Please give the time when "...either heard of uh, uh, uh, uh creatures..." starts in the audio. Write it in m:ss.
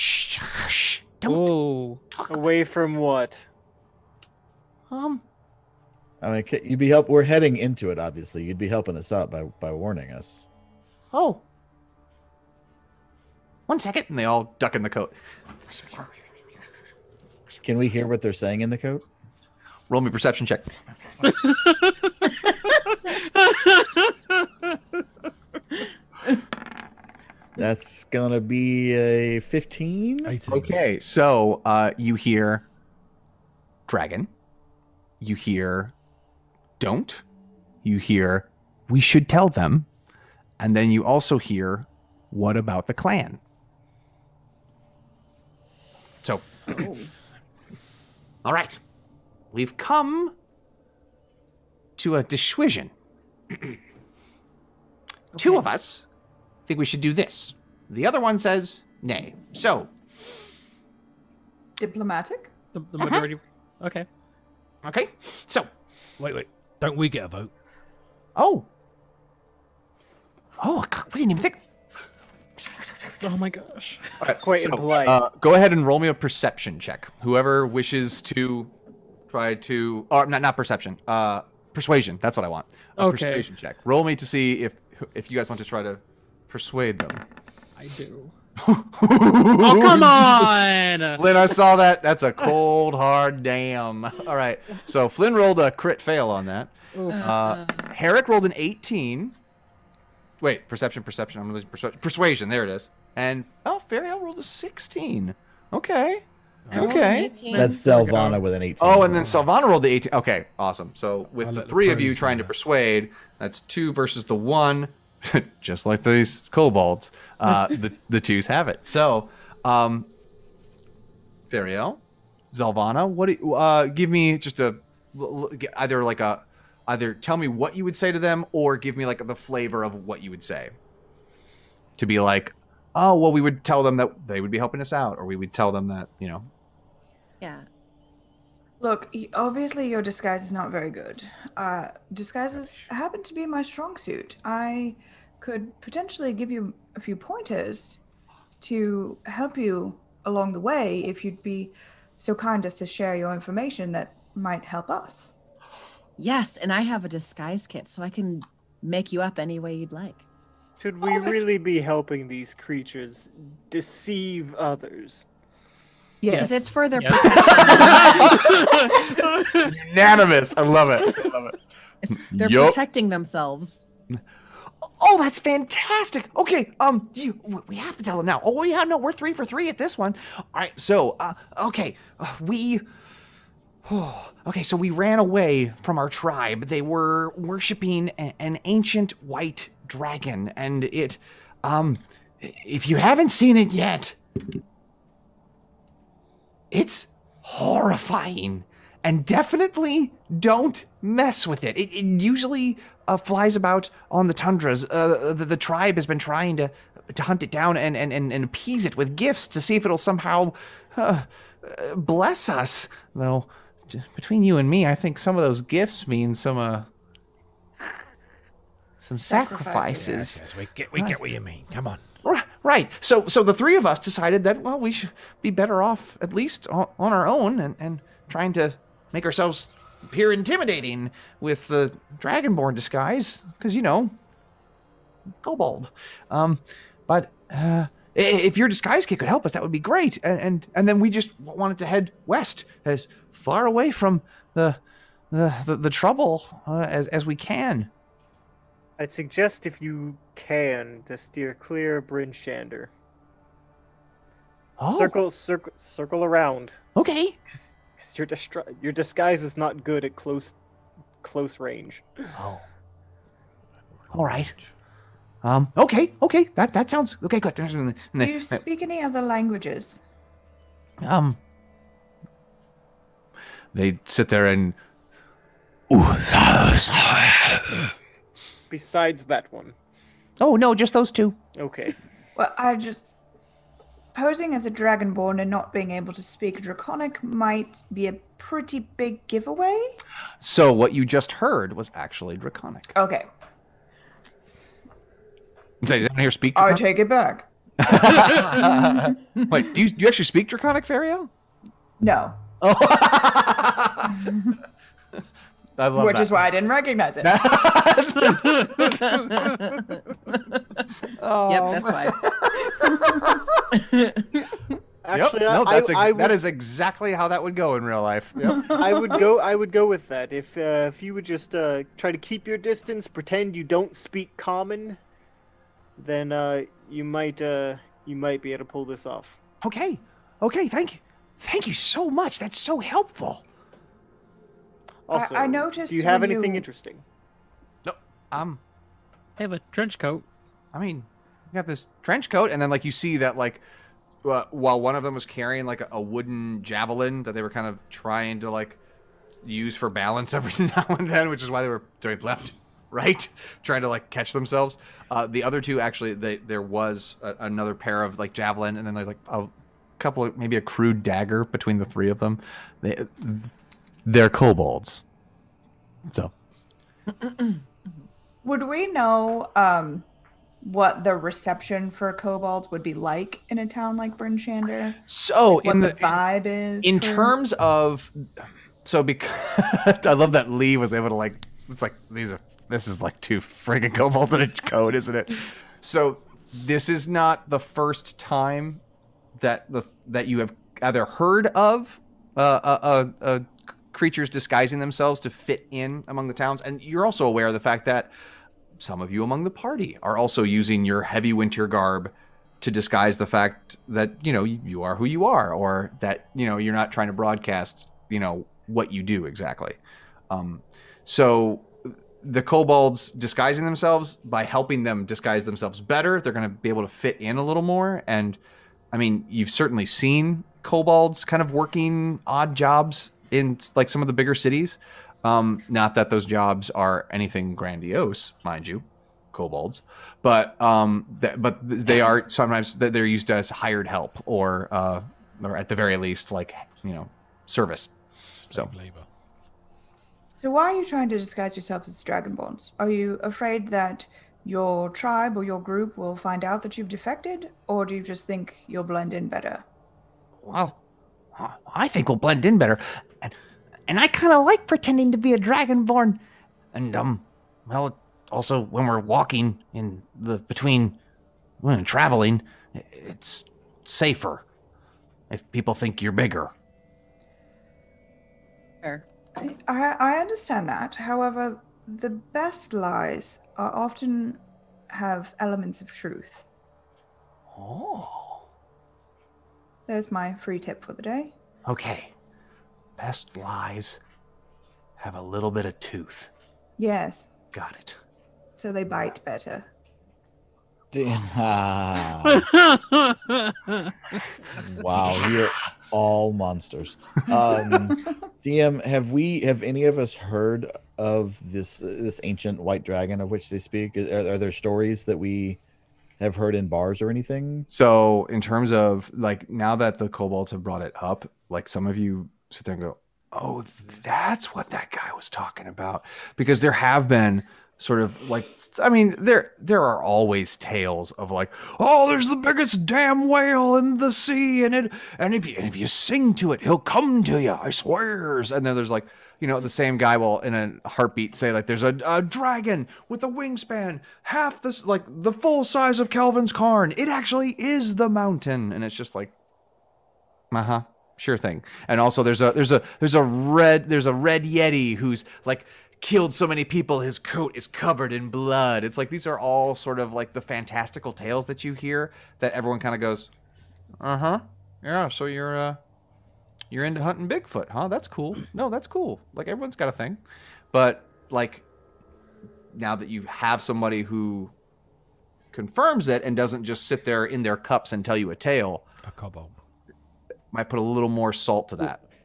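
6:30.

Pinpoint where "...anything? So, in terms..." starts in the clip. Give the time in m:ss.
8:27.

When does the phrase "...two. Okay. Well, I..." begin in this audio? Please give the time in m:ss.
4:41.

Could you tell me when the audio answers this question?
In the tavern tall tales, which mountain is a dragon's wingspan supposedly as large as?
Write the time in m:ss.
8:56.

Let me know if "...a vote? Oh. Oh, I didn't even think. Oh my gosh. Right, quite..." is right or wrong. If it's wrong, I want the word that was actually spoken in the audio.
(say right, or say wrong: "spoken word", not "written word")
right.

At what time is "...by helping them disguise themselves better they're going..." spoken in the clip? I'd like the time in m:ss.
6:54.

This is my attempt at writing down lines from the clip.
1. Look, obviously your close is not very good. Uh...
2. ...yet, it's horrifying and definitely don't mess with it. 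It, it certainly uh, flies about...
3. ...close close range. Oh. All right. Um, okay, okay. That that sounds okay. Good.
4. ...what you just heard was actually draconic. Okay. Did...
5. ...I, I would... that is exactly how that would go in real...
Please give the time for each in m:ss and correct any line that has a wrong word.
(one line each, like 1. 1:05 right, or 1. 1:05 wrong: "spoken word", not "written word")
1. 2:18 wrong: "disguise", not "close"
2. 3:13 wrong: "usually", not "certainly"
3. 4:20 right
4. 4:50 right
5. 5:15 right.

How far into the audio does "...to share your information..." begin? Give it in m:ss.
2:32.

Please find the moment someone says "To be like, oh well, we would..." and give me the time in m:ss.
2:11.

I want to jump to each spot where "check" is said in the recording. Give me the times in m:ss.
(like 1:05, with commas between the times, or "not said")
0:20, 1:16, 1:23.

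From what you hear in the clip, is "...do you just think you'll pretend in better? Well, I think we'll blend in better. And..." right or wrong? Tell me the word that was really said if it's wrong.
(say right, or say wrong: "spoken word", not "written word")
wrong: "blend", not "pretend".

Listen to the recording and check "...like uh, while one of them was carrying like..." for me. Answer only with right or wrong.
right.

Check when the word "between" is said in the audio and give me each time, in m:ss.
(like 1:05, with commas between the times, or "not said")
3:34, 6:01, 7:40.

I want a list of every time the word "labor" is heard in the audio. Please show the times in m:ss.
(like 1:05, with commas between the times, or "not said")
7:18.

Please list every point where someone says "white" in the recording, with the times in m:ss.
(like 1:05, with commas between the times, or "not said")
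3:09, 8:22.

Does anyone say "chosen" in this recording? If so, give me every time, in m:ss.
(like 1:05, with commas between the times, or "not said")
not said.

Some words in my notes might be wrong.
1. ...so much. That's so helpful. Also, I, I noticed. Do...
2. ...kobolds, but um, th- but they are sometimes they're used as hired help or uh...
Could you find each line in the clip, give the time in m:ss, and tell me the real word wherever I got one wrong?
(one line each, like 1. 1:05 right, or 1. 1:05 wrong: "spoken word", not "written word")
1. 5:31 right
2. 7:09 right.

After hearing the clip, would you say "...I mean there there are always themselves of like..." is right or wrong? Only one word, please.
wrong.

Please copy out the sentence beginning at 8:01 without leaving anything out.
Okay best lies have a little bit of tooth.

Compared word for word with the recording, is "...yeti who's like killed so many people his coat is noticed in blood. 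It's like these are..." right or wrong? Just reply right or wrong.
wrong.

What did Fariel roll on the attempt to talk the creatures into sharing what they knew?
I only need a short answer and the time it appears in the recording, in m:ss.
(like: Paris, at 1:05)
16, at 1:43.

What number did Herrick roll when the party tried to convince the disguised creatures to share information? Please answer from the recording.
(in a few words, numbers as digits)
18.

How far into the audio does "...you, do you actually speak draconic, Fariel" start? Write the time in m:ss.
4:59.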